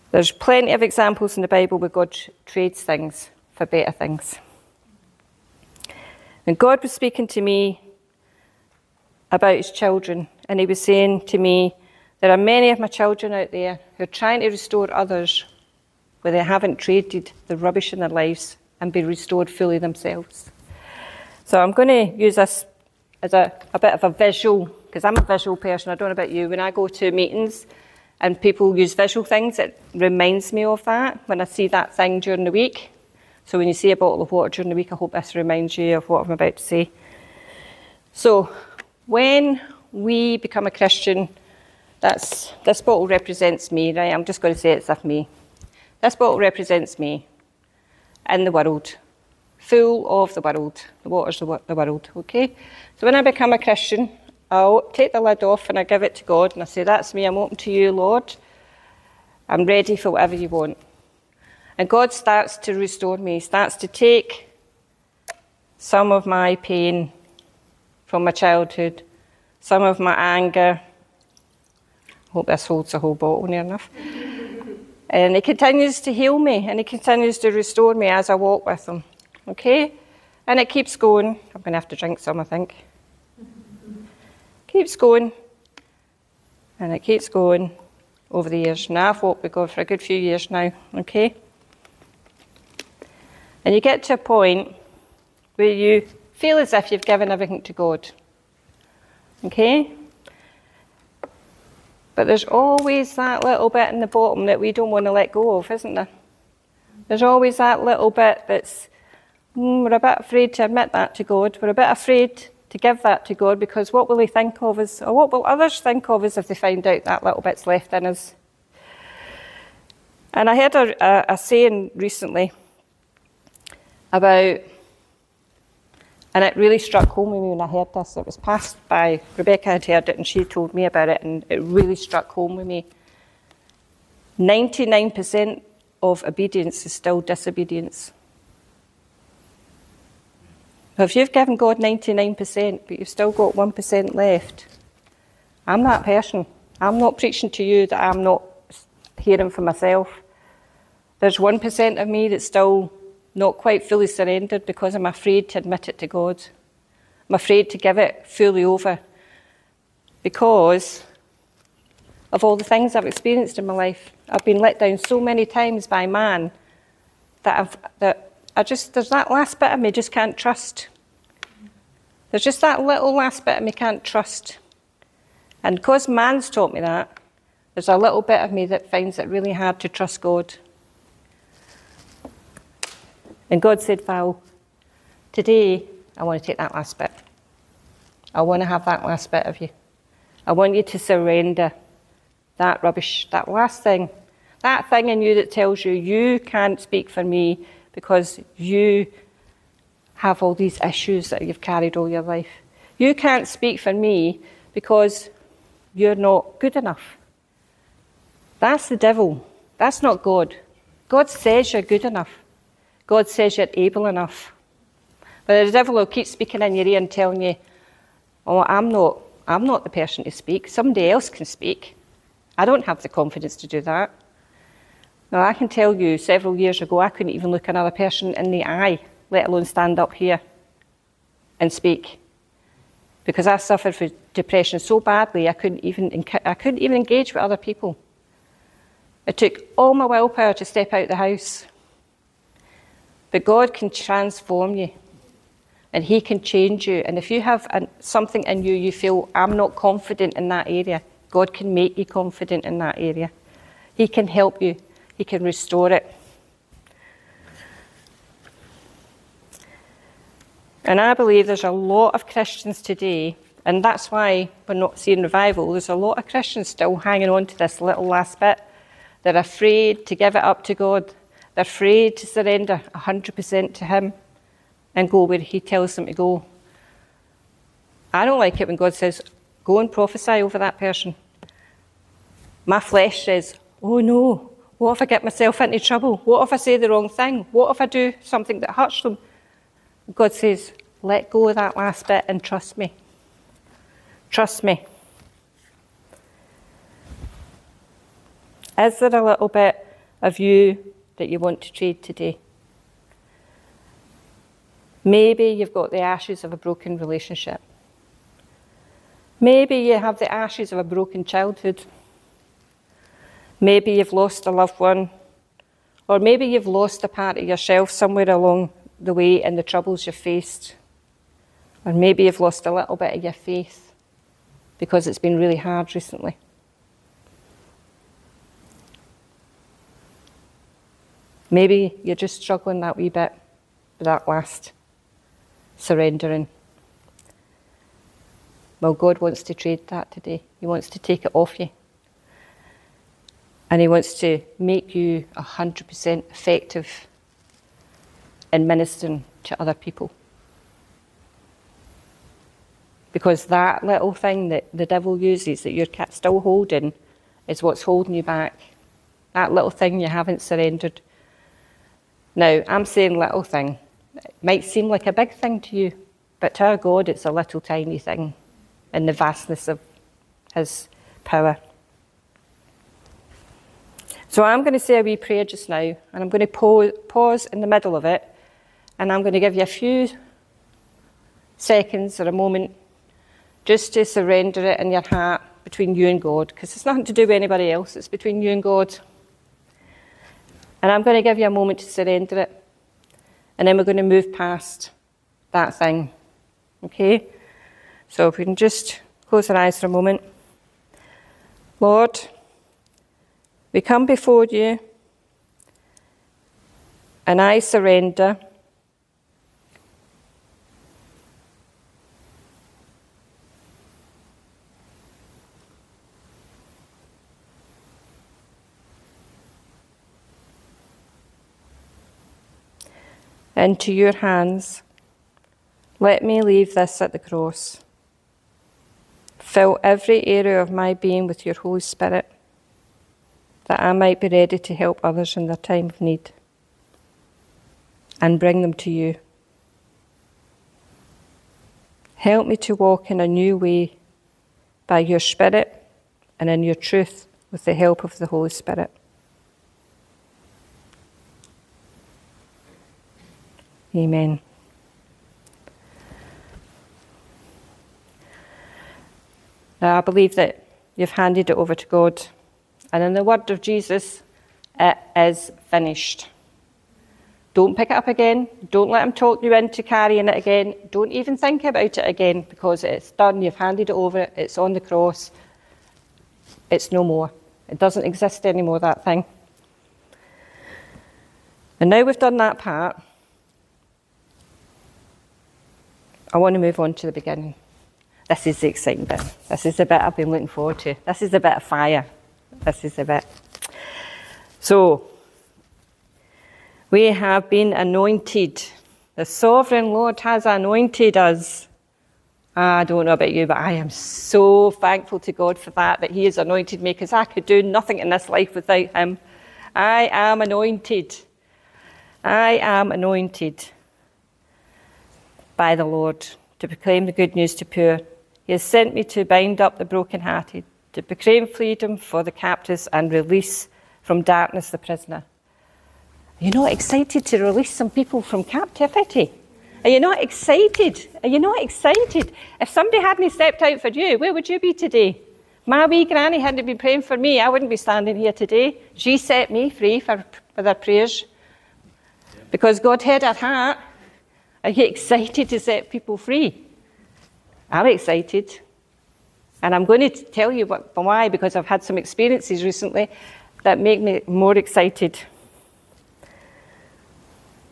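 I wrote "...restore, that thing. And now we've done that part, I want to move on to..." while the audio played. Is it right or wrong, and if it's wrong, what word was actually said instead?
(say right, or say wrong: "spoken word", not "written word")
wrong: "anymore", not "restore".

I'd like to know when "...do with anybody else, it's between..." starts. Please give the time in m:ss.
6:27.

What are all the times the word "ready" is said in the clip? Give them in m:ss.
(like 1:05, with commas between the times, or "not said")
0:59, 7:14.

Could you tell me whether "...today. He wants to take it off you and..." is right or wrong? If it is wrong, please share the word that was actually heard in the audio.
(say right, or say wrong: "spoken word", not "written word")
right.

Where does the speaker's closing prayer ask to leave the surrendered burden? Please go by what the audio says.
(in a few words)
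at the cross.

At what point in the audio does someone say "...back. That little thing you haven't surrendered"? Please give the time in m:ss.
5:58.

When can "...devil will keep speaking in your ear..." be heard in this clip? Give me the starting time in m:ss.
3:35.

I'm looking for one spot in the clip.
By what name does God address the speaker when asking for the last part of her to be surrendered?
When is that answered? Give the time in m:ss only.
3:04.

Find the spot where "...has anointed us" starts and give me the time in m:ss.
8:20.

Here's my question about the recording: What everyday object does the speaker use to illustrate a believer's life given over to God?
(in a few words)
bottle of water.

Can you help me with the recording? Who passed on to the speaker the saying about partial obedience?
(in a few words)
Rebecca.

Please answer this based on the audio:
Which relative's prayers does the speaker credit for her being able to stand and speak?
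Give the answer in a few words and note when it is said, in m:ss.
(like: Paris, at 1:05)
granny, at 8:56.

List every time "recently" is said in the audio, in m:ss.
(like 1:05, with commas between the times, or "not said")
2:01, 5:25, 9:12.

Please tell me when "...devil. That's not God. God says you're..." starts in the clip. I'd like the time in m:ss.
3:28.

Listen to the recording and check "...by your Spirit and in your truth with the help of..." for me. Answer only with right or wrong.
right.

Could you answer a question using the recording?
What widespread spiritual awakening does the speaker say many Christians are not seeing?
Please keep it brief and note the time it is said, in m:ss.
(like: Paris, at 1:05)
revival, at 4:25.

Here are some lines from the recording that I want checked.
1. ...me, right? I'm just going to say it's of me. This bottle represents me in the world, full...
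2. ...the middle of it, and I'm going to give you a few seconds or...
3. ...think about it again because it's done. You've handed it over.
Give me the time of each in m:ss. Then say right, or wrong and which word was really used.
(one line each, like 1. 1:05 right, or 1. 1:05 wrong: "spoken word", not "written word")
1. 0:43 right
2. 6:17 right
3. 7:51 right.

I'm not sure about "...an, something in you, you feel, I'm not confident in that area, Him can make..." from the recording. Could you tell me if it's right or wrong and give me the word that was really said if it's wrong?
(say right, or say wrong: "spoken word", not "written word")
wrong: "God", not "Him".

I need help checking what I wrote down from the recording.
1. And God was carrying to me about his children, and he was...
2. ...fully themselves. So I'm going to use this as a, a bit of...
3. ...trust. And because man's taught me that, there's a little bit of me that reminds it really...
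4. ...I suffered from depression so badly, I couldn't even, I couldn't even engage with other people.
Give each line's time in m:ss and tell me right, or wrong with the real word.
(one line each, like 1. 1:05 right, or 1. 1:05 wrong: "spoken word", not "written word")
1. 0:06 wrong: "speaking", not "carrying"
2. 0:19 right
3. 2:54 wrong: "finds", not "reminds"
4. 3:53 right.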